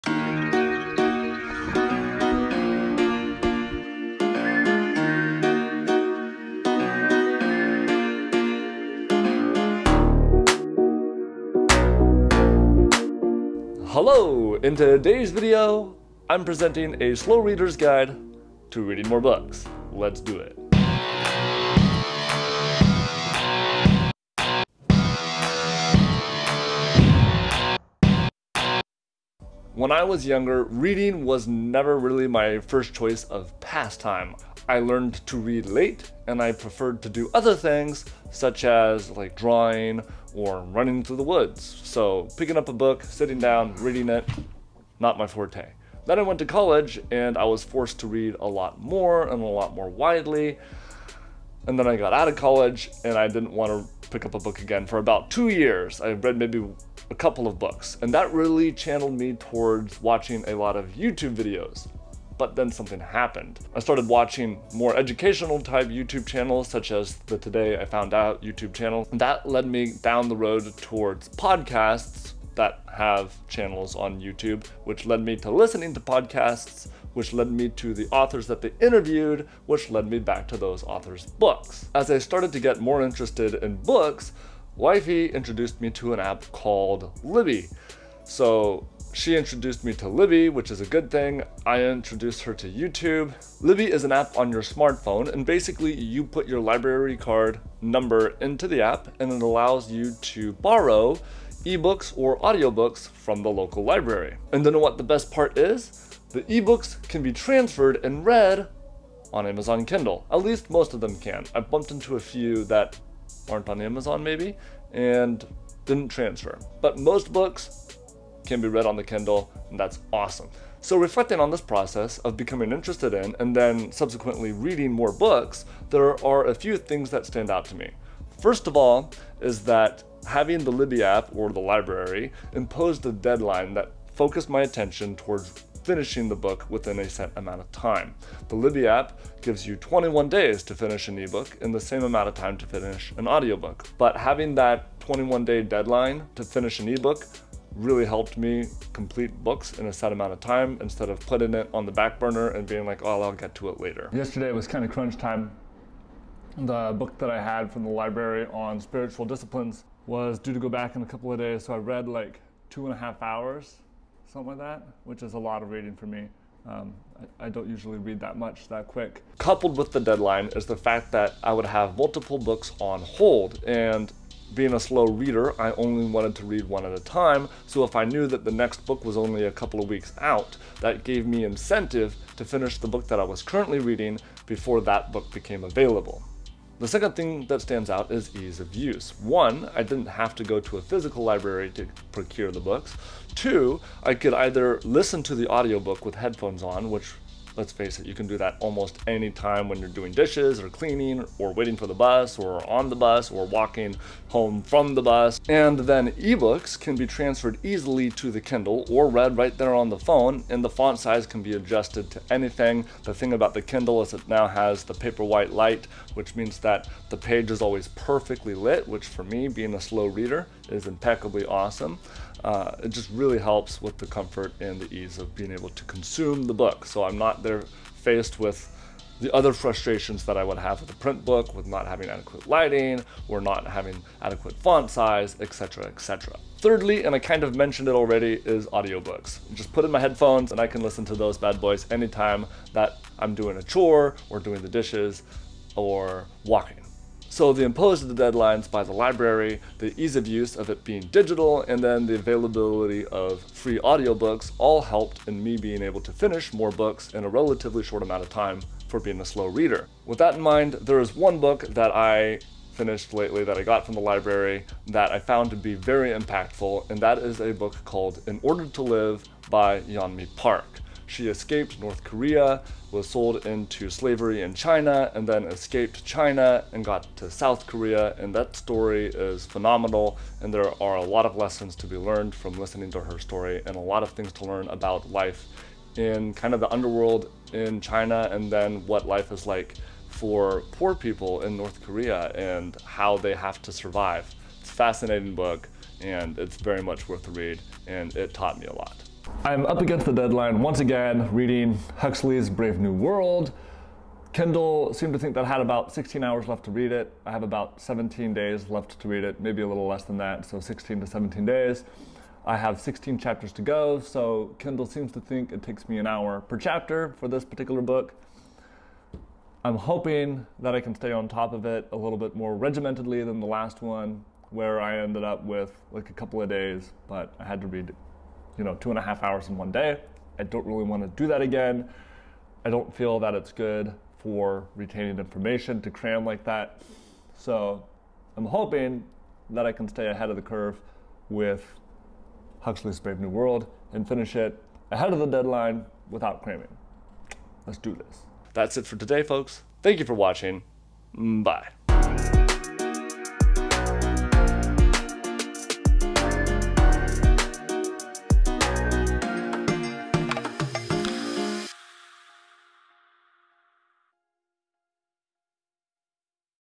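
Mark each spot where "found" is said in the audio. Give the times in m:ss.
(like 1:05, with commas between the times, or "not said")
1:07, 4:25.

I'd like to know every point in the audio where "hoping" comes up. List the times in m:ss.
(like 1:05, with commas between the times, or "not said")
5:19, 5:38.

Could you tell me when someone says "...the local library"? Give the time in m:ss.
1:43.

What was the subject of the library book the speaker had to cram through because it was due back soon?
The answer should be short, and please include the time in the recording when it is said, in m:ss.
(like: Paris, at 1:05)
spiritual disciplines, at 2:38.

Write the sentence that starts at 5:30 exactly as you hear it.
I don't really want to do that again.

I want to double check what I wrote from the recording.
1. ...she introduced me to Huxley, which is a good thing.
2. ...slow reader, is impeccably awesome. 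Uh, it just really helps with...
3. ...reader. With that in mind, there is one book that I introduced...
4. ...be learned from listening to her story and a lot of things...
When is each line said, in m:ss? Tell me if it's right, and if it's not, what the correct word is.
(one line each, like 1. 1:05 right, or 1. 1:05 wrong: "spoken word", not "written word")
1. 1:29 wrong: "Libby", not "Huxley"
2. 3:39 right
3. 4:19 wrong: "finished", not "introduced"
4. 4:41 right.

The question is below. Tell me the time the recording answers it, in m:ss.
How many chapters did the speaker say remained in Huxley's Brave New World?
5:12.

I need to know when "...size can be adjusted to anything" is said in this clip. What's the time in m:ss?
3:30.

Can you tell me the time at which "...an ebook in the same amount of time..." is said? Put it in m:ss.
2:21.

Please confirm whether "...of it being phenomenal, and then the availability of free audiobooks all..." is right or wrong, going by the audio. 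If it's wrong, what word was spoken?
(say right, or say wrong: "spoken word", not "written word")
wrong: "digital", not "phenomenal".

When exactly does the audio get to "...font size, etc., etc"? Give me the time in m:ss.
3:54.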